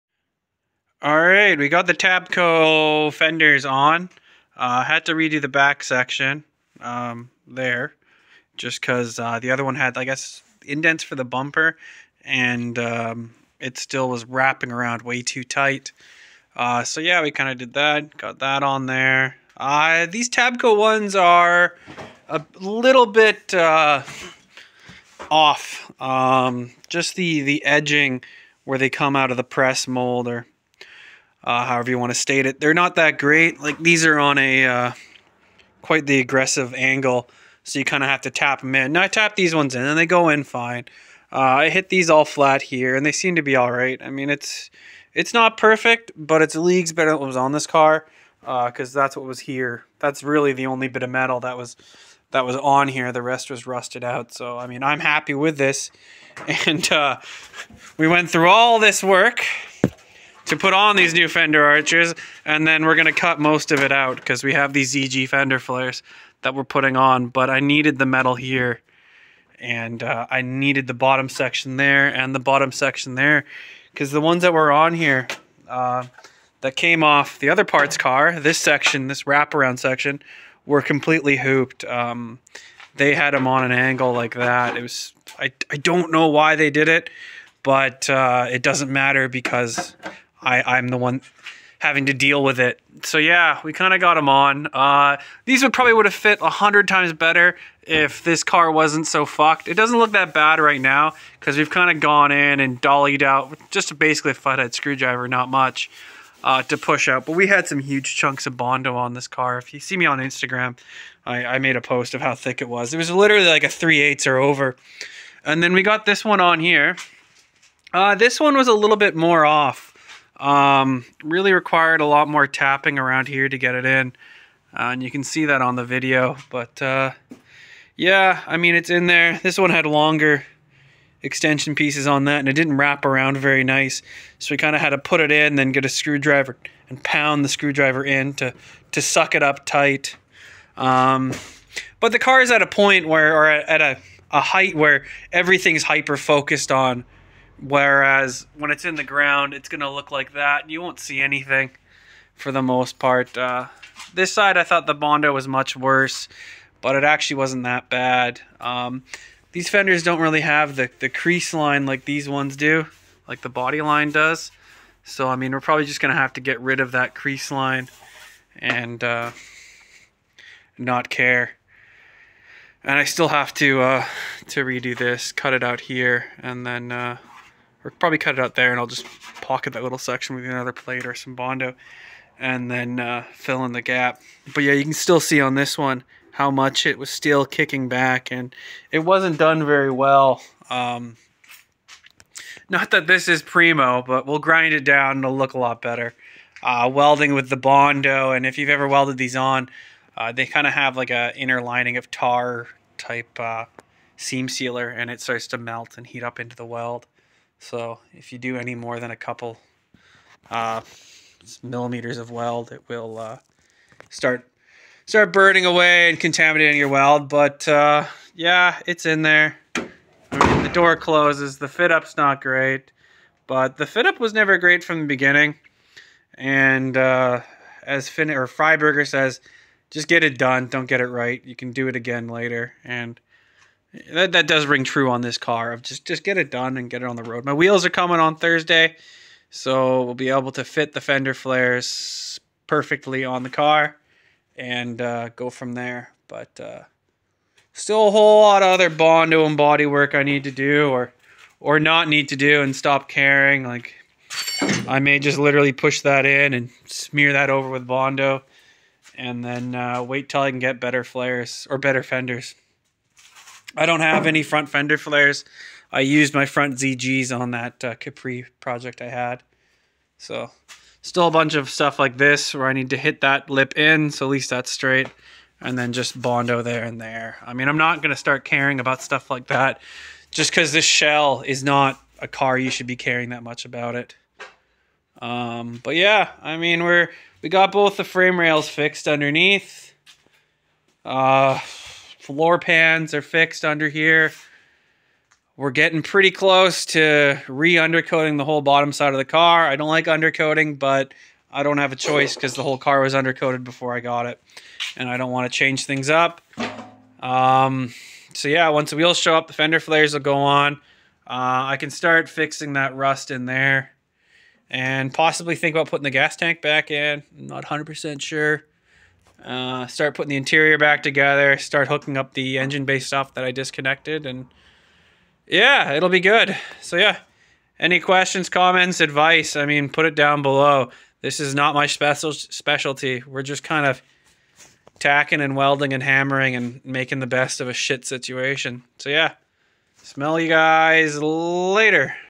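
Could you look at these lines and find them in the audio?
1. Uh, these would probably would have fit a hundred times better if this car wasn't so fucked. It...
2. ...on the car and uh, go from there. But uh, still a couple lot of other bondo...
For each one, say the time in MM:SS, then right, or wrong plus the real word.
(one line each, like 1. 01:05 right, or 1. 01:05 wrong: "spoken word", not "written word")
1. 01:34 right
2. 04:03 wrong: "whole", not "couple".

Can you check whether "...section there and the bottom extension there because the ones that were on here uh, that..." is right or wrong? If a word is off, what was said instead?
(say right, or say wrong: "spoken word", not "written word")
wrong: "section", not "extension".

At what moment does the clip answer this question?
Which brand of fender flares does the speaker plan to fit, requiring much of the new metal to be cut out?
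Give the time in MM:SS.
01:04.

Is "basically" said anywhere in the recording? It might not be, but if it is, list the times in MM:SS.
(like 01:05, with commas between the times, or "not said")
01:43.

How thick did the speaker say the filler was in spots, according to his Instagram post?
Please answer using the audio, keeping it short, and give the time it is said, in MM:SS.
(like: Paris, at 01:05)
3/8, at 01:53.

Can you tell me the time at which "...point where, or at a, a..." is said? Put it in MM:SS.
02:22.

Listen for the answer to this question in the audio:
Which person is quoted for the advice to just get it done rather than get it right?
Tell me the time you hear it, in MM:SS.
03:48.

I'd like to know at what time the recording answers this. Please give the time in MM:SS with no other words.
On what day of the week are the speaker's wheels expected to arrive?
03:58.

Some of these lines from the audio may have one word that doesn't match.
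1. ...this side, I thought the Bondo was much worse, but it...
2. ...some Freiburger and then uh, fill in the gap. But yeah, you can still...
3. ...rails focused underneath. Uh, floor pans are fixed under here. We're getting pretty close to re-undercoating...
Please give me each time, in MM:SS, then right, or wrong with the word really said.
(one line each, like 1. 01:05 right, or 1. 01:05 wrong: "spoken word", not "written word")
1. 02:34 right
2. 03:01 wrong: "Bondo", not "Freiburger"
3. 04:48 wrong: "fixed", not "focused".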